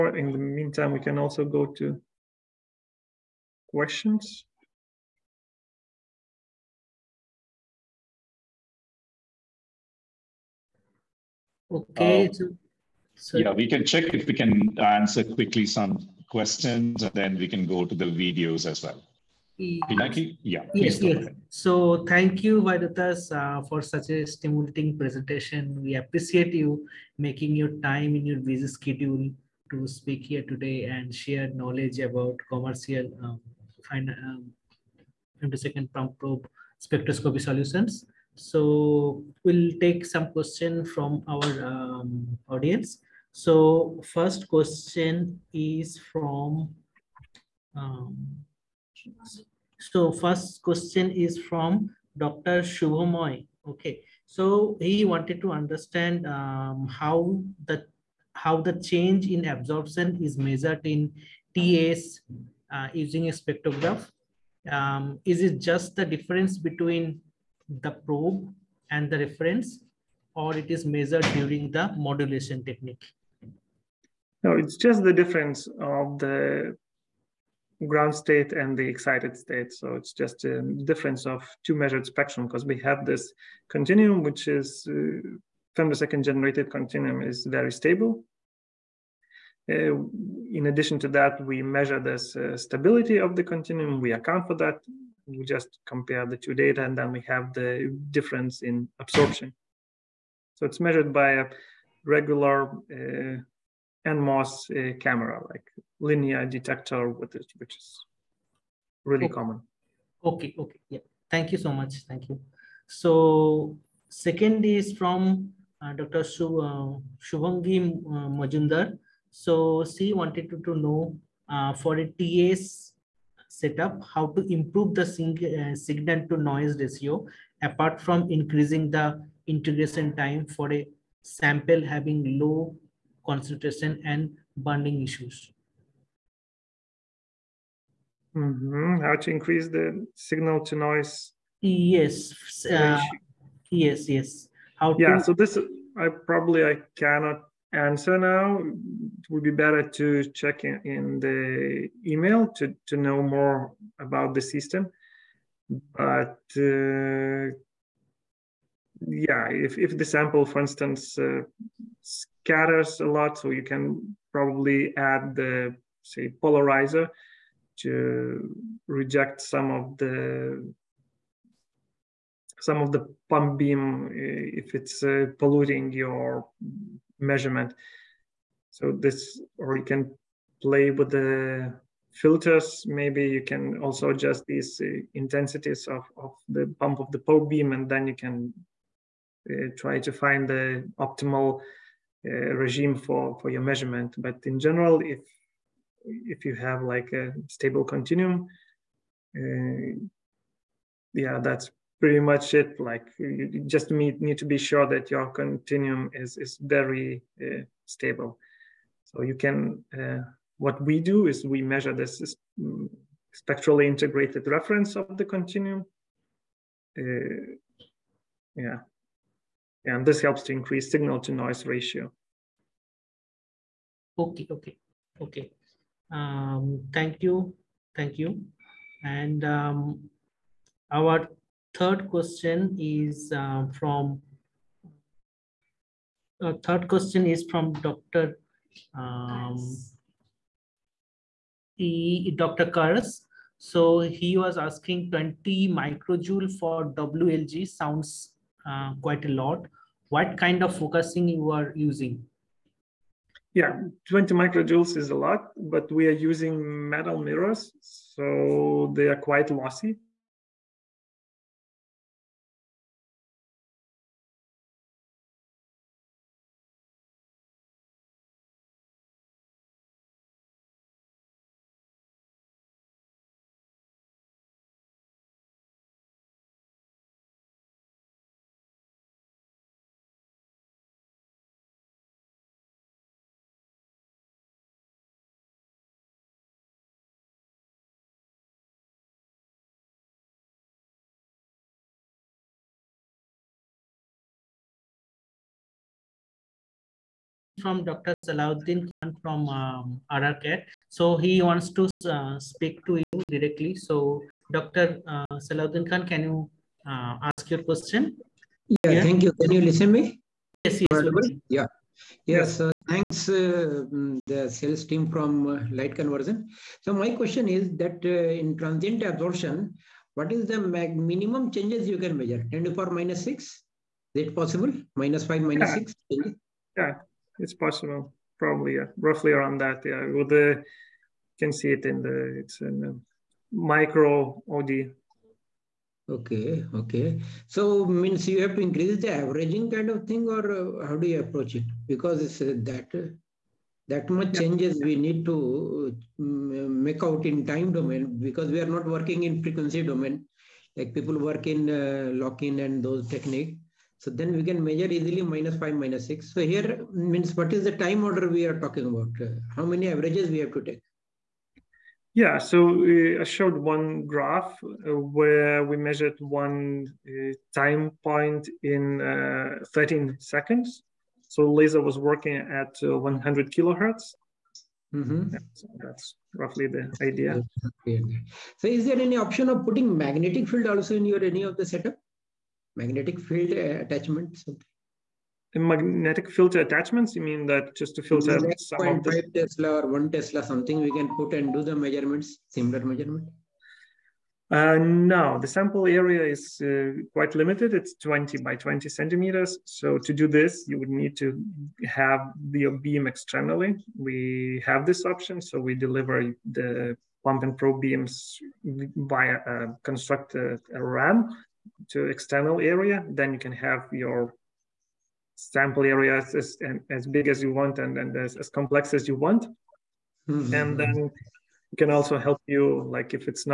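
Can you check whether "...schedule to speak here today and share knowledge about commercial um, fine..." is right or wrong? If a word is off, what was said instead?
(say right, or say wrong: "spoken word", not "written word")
right.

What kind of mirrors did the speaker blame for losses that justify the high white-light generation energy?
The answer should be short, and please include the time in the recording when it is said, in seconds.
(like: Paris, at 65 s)
Metal mirrors, at 256 s.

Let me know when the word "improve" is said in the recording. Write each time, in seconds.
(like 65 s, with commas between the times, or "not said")
124 s.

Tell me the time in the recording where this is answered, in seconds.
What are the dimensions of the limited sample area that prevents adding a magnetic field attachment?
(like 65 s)
397 s.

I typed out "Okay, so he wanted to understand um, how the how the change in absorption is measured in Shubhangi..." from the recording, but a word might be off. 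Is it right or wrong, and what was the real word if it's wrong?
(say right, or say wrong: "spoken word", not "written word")
wrong: "TAs", not "Shubhangi".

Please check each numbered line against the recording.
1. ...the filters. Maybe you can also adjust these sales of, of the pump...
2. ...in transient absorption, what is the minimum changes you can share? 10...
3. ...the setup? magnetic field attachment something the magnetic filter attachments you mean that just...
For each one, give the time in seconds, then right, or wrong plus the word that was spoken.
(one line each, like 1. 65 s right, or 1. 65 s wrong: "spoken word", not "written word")
1. 181 s wrong: "intensities", not "sales"
2. 318 s wrong: "measure", not "share"
3. 381 s right.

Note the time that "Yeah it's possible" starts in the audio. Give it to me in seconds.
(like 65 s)
326 s.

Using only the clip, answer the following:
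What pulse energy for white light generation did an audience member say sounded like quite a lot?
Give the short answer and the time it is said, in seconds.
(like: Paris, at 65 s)
20 microjoules, at 245 s.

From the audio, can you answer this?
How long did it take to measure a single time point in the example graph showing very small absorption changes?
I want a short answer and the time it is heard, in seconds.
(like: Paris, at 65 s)
13 seconds, at 369 s.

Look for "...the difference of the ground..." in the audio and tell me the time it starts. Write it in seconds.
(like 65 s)
75 s.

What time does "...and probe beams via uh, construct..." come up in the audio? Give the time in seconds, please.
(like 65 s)
407 s.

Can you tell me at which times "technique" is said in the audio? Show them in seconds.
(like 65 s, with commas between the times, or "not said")
72 s, 353 s.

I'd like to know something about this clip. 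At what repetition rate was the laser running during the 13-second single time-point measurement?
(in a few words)
100 kHz.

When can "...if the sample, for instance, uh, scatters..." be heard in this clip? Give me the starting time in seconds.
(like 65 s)
159 s.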